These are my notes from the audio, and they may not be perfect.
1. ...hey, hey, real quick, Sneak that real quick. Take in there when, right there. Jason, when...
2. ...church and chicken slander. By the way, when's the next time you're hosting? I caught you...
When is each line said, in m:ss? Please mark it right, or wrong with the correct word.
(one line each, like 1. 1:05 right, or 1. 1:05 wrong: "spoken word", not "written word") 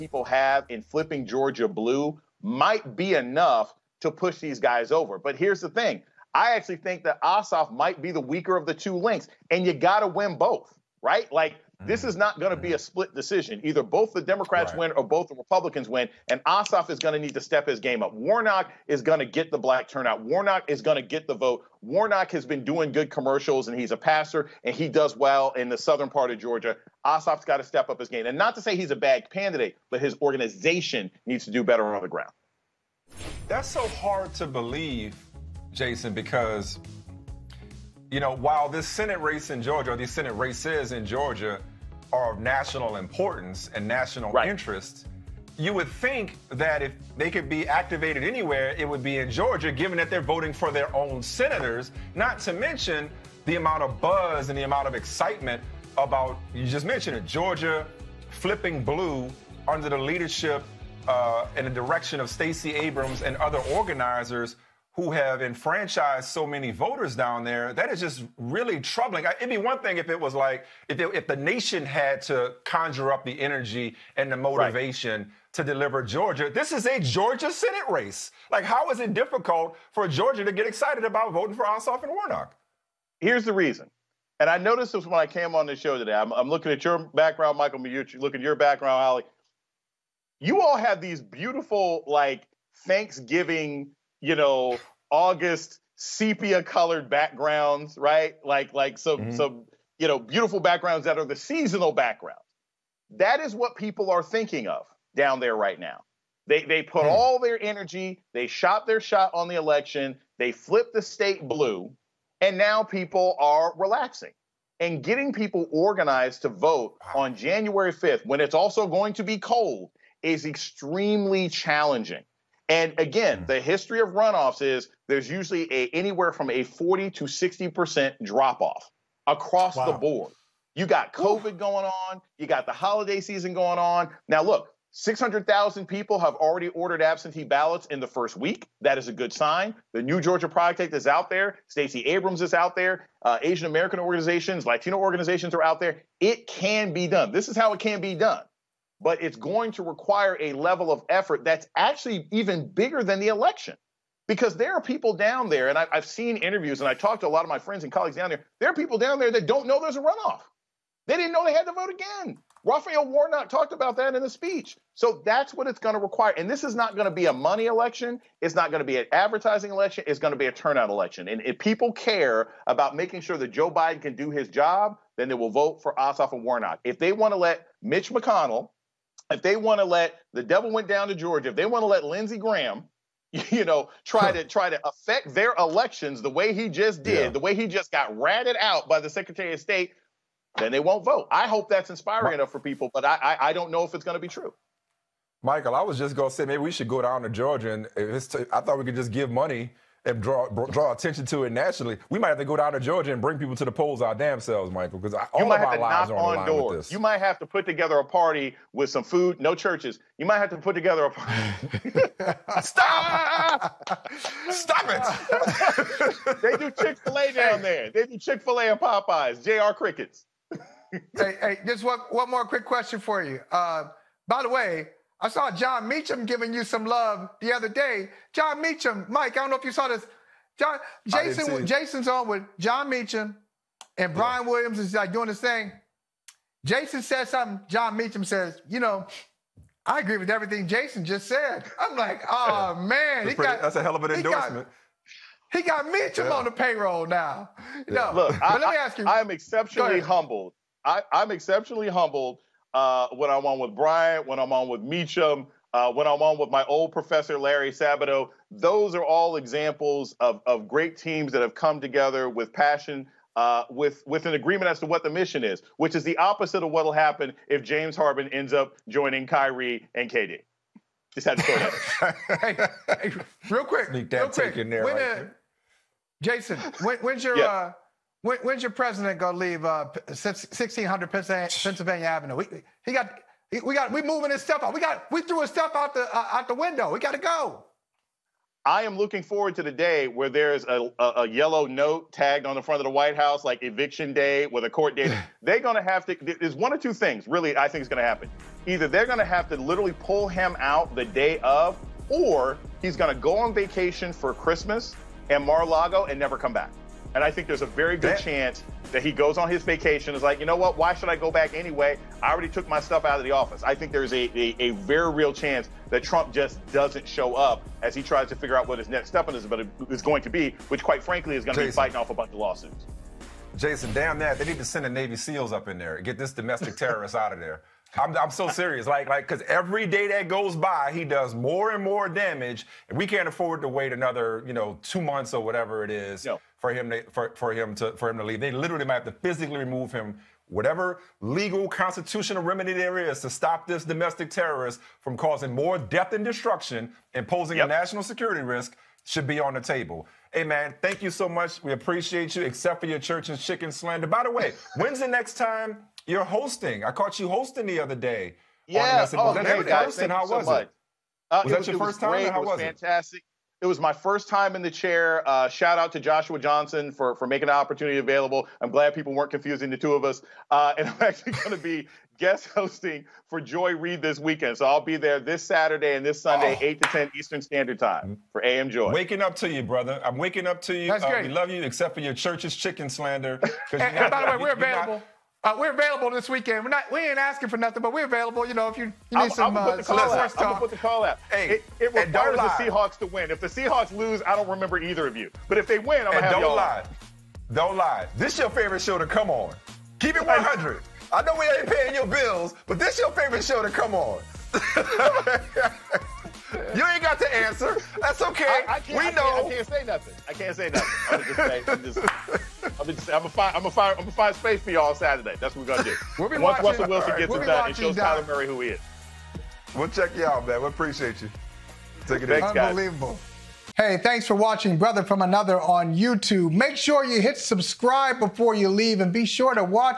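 1. 4:32 right
2. 5:52 right.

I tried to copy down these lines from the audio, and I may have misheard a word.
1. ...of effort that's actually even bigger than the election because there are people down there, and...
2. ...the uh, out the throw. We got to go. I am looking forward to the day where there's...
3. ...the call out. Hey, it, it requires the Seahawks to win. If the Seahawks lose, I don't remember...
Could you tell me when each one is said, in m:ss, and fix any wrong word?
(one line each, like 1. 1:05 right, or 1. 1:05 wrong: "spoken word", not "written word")
1. 2:30 right
2. 4:45 wrong: "window", not "throw"
3. 6:30 right.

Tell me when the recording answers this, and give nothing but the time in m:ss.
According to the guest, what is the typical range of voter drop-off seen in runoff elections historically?
2:06.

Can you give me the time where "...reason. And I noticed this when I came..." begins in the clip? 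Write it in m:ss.
1:23.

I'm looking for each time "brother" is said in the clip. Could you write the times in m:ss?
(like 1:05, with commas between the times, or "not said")
6:19, 7:04.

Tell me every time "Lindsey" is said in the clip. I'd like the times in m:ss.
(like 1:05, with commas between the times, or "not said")
3:02.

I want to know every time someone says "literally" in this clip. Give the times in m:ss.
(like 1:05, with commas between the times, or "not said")
4:59, 5:38.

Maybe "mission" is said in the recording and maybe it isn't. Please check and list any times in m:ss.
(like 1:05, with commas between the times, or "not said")
4:25.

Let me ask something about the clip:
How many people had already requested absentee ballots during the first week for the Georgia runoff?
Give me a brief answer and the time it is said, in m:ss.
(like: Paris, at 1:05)
600,000, at 2:14.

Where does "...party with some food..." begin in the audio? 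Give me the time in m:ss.
3:28.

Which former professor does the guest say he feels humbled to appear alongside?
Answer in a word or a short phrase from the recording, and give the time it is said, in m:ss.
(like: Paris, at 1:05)
Larry Sabato, at 4:17.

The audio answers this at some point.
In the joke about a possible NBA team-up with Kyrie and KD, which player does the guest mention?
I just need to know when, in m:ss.
4:27.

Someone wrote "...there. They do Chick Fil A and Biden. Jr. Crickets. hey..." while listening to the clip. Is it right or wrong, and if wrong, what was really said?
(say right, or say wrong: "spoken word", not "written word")
wrong: "Popeyes", not "Biden".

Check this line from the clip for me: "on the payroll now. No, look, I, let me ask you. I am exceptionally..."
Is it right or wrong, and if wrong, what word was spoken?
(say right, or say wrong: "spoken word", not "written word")
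right.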